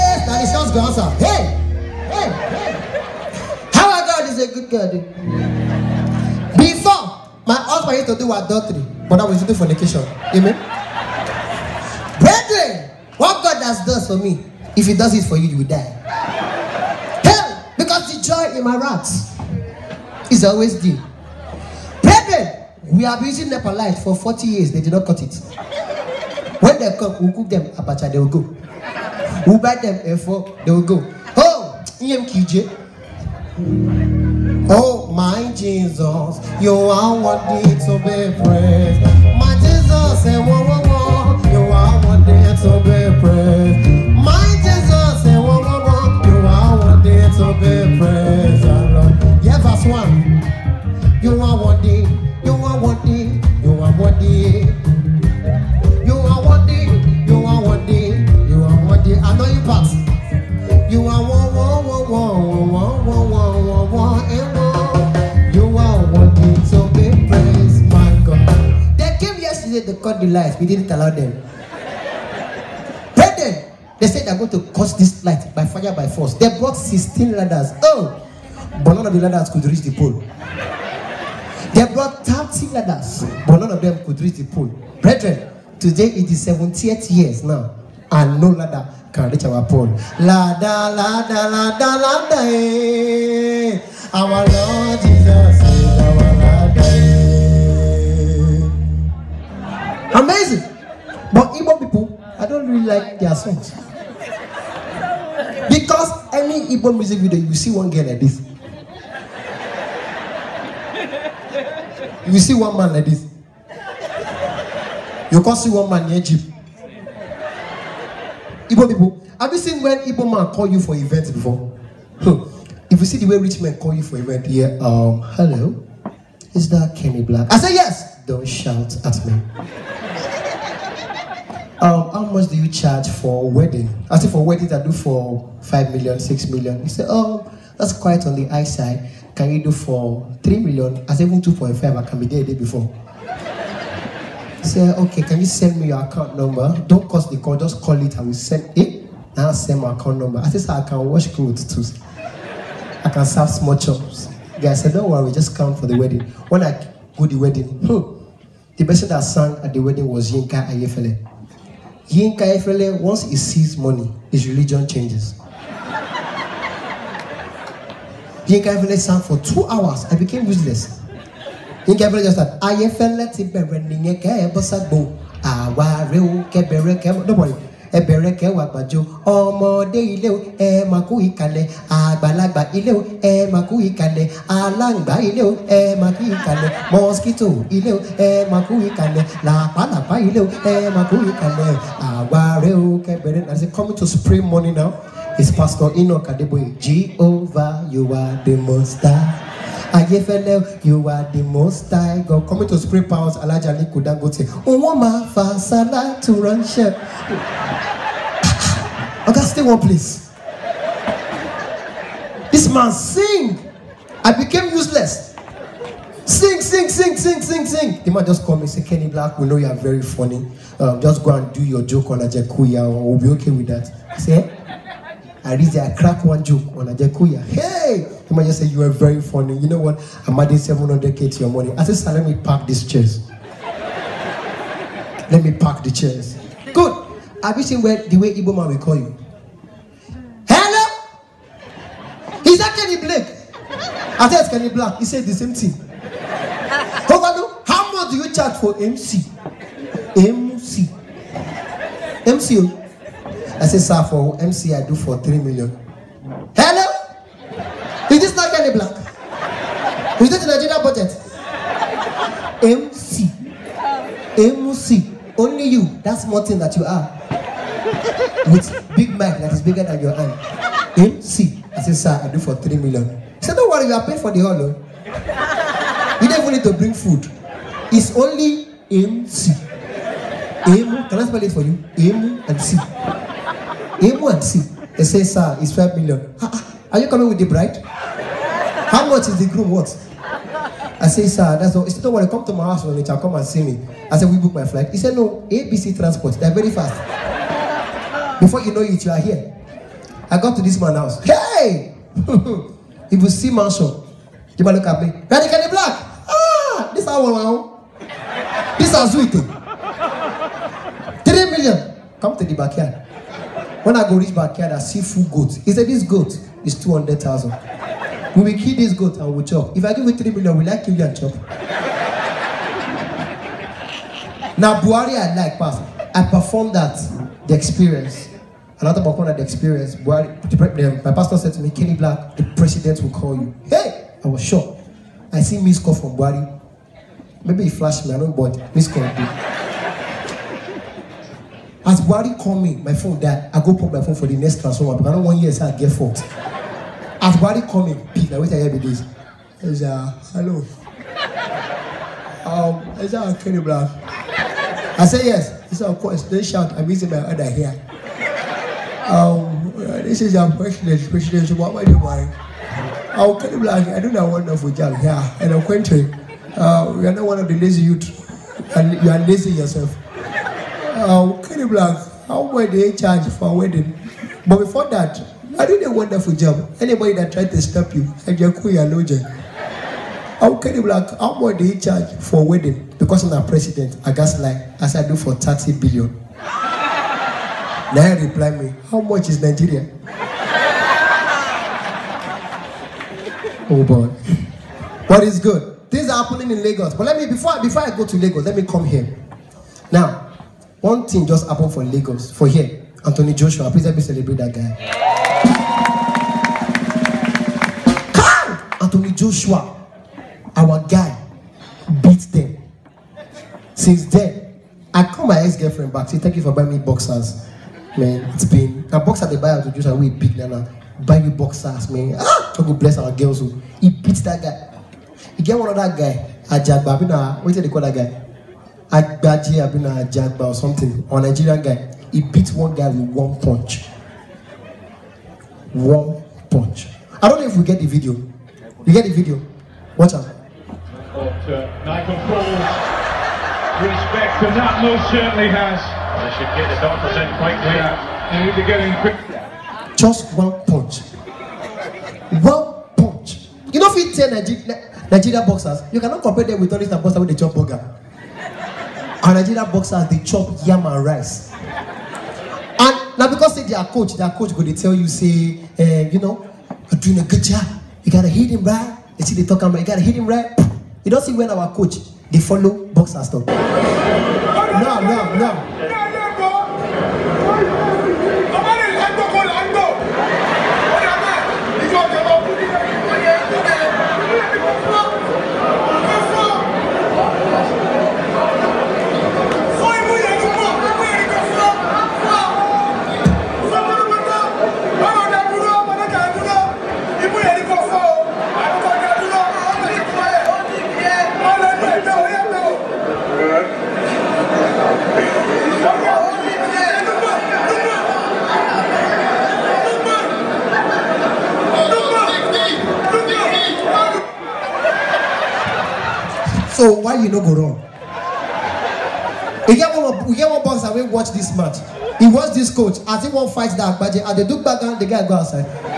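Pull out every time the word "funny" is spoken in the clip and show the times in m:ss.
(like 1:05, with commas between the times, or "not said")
3:40, 3:49.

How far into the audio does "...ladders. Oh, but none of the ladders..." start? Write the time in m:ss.
1:17.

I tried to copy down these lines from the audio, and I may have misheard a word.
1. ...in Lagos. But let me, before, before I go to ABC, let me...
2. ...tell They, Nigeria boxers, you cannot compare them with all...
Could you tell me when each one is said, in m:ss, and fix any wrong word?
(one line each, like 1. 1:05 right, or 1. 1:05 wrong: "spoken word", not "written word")
1. 6:36 wrong: "Lagos", not "ABC"
2. 7:34 wrong: "Nigeria", not "They".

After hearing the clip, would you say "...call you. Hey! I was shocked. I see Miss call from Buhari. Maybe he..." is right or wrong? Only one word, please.
right.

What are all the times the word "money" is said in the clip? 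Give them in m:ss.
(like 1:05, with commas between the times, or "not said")
2:43, 3:14, 3:51.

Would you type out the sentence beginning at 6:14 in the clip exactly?
But before that, I did a wonderful job.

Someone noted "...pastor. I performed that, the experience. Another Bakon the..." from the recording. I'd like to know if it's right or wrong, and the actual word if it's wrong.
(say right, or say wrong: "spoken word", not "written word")
right.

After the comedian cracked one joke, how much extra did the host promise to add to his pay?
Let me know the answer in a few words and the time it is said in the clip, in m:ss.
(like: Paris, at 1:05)
700k, at 3:50.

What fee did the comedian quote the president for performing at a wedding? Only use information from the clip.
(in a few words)
30 billion.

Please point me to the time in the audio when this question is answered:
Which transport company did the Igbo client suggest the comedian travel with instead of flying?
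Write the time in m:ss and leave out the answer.
4:55.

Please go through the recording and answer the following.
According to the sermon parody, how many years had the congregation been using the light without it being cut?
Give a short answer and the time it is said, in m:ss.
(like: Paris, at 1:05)
40, at 0:24.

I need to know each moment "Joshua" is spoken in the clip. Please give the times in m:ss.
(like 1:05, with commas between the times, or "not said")
6:43, 6:49, 6:59.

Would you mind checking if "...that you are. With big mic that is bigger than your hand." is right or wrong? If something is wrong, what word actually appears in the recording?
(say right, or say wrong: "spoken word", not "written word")
right.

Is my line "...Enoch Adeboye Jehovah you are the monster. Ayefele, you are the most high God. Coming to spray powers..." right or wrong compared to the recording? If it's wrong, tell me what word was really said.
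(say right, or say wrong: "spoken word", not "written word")
right.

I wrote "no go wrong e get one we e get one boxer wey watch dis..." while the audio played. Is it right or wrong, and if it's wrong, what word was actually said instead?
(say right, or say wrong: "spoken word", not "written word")
right.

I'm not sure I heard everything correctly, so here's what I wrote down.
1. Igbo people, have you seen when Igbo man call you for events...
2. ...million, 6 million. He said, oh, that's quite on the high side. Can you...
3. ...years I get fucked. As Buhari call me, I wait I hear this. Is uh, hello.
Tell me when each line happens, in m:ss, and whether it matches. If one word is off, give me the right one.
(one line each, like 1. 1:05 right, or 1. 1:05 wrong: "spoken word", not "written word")
1. 1:58 right
2. 2:15 right
3. 5:45 right.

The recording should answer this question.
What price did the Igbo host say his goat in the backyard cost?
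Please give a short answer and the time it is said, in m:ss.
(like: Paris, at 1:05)
200,000, at 5:16.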